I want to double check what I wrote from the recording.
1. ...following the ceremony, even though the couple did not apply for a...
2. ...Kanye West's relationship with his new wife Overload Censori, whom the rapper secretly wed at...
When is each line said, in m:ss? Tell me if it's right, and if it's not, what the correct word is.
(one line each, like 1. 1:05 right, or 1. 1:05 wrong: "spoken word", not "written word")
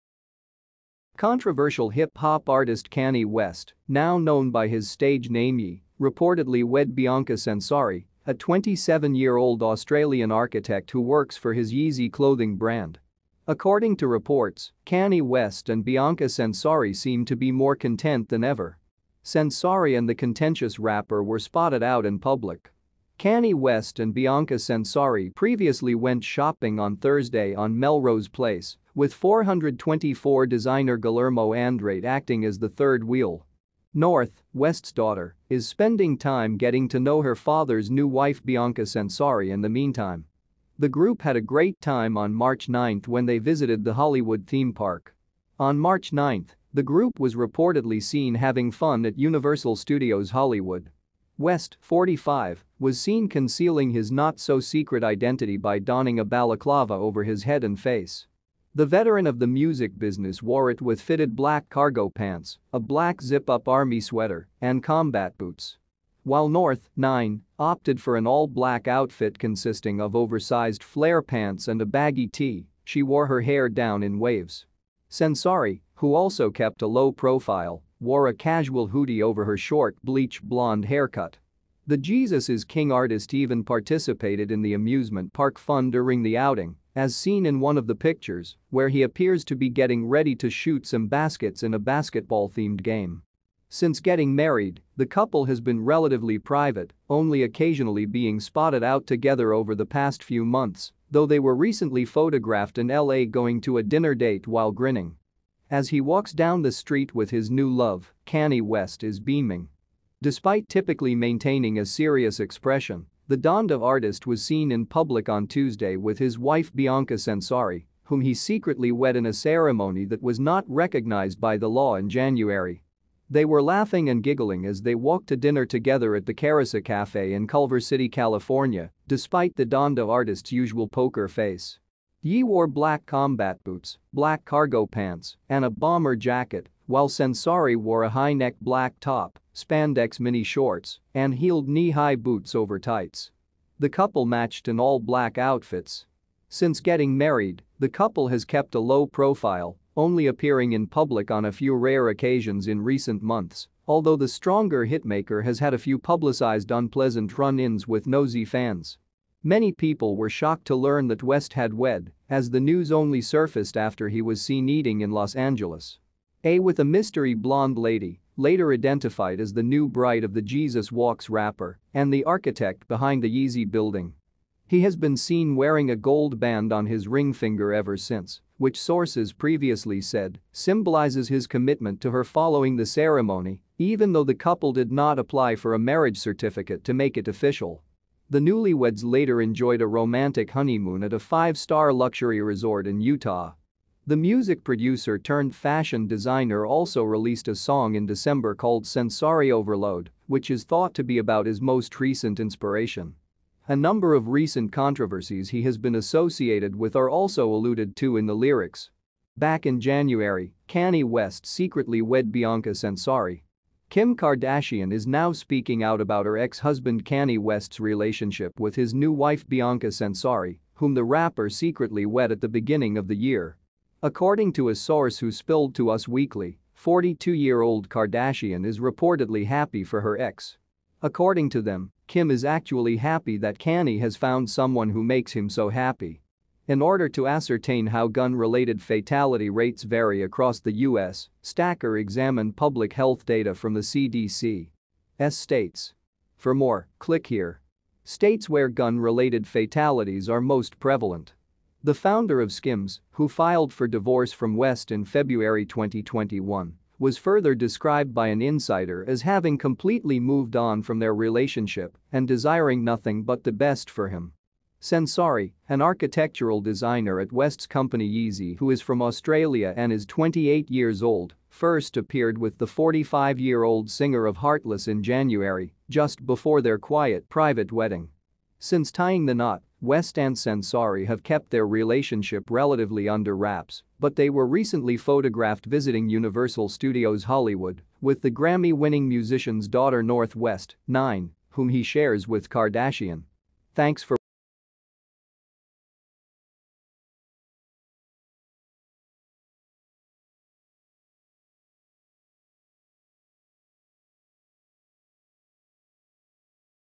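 1. 3:02 right
2. 3:37 wrong: "Bianca", not "Overload".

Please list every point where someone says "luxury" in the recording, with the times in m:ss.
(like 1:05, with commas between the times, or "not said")
3:11.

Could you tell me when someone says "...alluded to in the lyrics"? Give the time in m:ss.
3:27.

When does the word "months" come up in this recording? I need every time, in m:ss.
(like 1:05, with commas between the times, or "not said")
1:40, 2:33.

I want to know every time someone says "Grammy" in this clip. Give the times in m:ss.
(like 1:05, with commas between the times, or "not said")
4:48.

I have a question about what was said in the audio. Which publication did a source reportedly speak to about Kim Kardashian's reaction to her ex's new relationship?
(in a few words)
Us Weekly.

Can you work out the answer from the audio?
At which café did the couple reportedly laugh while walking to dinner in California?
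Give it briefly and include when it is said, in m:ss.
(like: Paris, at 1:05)
Carissa Cafe, at 2:06.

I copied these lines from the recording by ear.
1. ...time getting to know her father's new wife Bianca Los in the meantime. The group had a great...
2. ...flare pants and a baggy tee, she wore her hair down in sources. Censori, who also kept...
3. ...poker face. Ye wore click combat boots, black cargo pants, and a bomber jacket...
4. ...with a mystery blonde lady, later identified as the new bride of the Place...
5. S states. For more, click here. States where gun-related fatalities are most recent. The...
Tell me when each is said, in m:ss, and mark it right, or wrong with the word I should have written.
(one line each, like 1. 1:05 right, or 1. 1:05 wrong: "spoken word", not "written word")
1. 0:36 wrong: "Censori", not "Los"
2. 1:10 wrong: "waves", not "sources"
3. 2:10 wrong: "black", not "click"
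4. 2:46 wrong: "Jesus", not "Place"
5. 4:05 wrong: "prevalent", not "recent".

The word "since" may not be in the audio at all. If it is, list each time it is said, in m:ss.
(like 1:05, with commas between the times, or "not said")
1:33, 2:26, 2:57, 4:38.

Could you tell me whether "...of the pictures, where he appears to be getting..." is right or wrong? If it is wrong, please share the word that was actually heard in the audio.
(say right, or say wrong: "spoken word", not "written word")
right.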